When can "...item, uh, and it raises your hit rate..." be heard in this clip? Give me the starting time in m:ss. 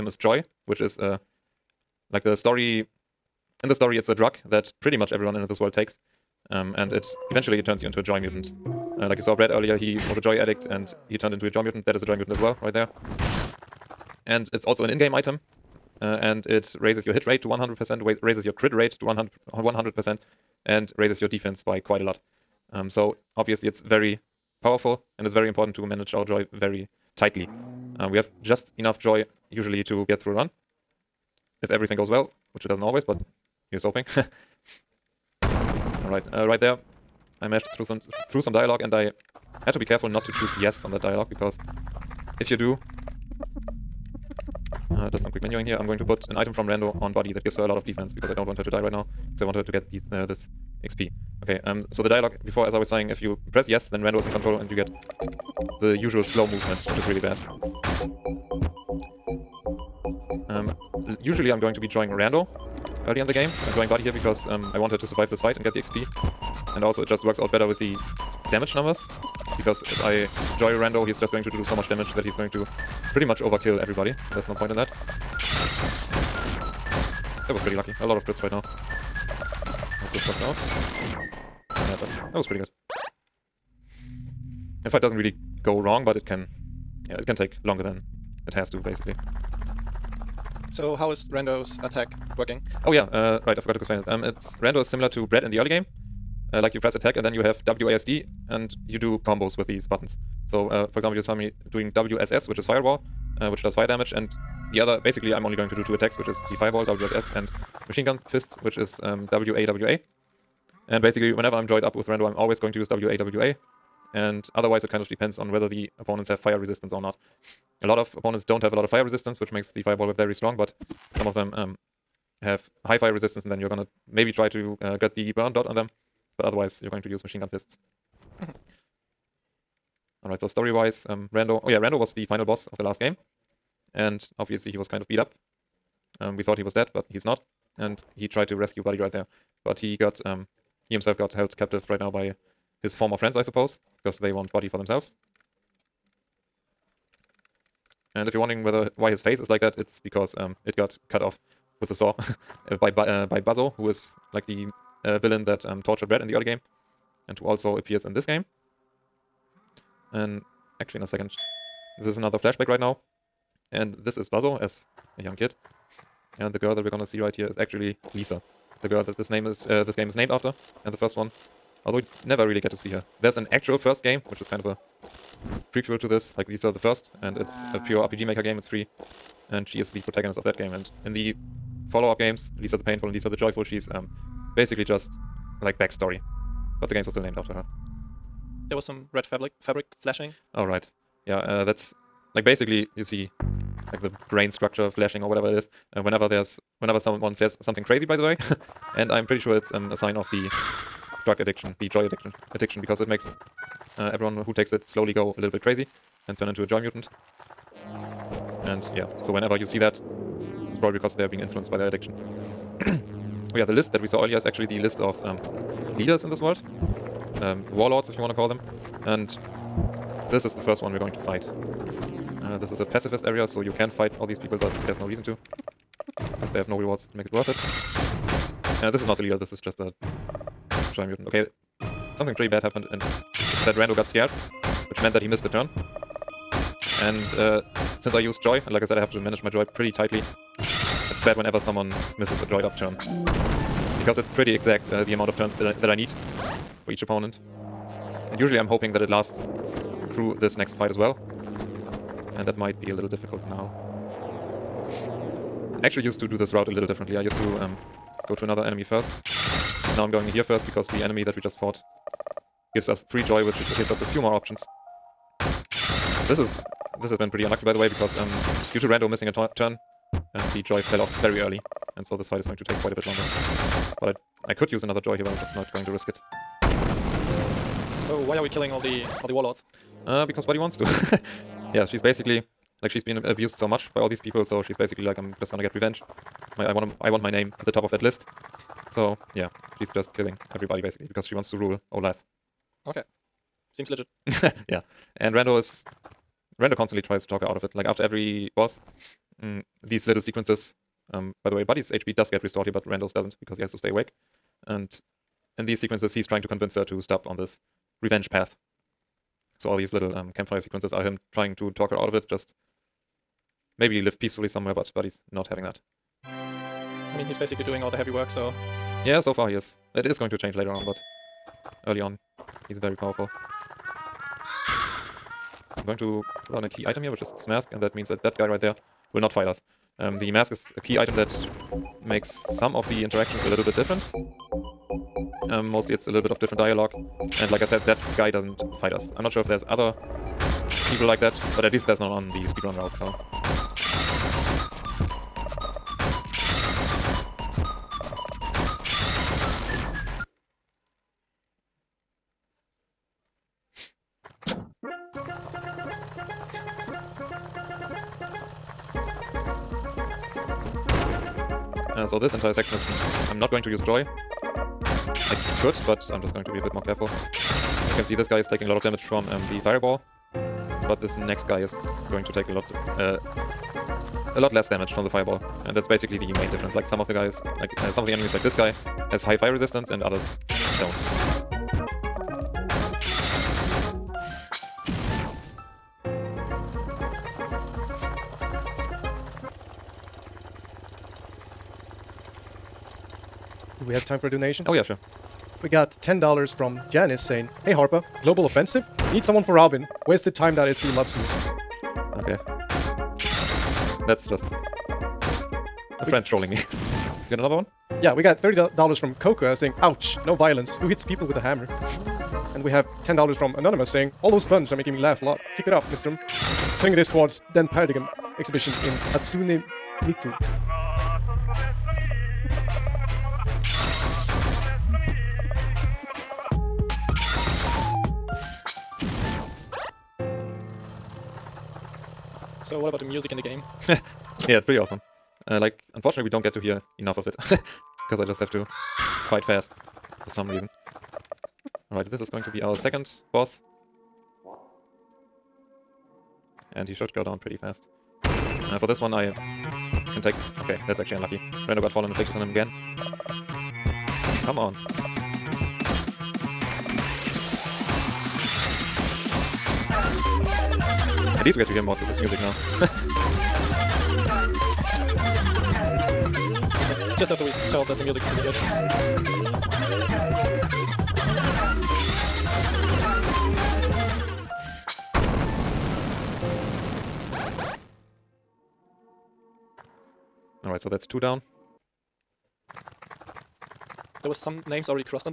0:15.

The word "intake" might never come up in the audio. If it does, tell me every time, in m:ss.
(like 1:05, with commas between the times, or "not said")
not said.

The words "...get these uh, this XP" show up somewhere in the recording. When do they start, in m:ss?
0:49.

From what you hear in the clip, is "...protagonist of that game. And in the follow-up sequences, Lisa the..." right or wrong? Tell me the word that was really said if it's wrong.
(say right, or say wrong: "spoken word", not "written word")
wrong: "games", not "sequences".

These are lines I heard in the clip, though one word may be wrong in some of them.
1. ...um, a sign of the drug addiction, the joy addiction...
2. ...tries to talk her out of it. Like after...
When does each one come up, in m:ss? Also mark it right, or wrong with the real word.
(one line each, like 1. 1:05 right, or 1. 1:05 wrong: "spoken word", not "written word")
1. 3:19 right
2. 4:57 right.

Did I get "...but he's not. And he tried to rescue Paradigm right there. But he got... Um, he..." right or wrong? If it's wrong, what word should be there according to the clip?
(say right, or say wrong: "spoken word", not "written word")
wrong: "Buddy", not "Paradigm".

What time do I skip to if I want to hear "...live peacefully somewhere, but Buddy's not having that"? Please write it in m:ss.
5:14.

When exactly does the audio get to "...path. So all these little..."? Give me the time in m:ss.
5:08.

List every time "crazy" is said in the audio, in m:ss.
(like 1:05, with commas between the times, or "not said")
3:17, 3:25.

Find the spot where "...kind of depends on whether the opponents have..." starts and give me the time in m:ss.
1:54.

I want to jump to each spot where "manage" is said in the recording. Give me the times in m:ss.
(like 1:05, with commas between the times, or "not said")
0:25, 3:59.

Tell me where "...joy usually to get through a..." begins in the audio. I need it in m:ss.
0:28.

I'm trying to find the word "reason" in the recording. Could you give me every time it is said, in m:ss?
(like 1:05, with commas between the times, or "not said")
3:45, 7:20.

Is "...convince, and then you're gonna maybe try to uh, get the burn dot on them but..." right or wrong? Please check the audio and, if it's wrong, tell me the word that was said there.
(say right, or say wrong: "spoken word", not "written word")
wrong: "resistance", not "convince".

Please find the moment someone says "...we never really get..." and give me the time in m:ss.
2:51.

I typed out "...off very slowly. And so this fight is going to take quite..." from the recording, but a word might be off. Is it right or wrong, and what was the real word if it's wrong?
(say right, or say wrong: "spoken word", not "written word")
wrong: "early", not "slowly".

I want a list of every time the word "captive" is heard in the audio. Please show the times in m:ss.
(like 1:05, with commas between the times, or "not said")
2:21.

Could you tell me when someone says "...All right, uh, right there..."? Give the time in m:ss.
0:36.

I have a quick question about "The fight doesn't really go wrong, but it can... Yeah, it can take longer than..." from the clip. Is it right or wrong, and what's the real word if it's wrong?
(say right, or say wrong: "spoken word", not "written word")
right.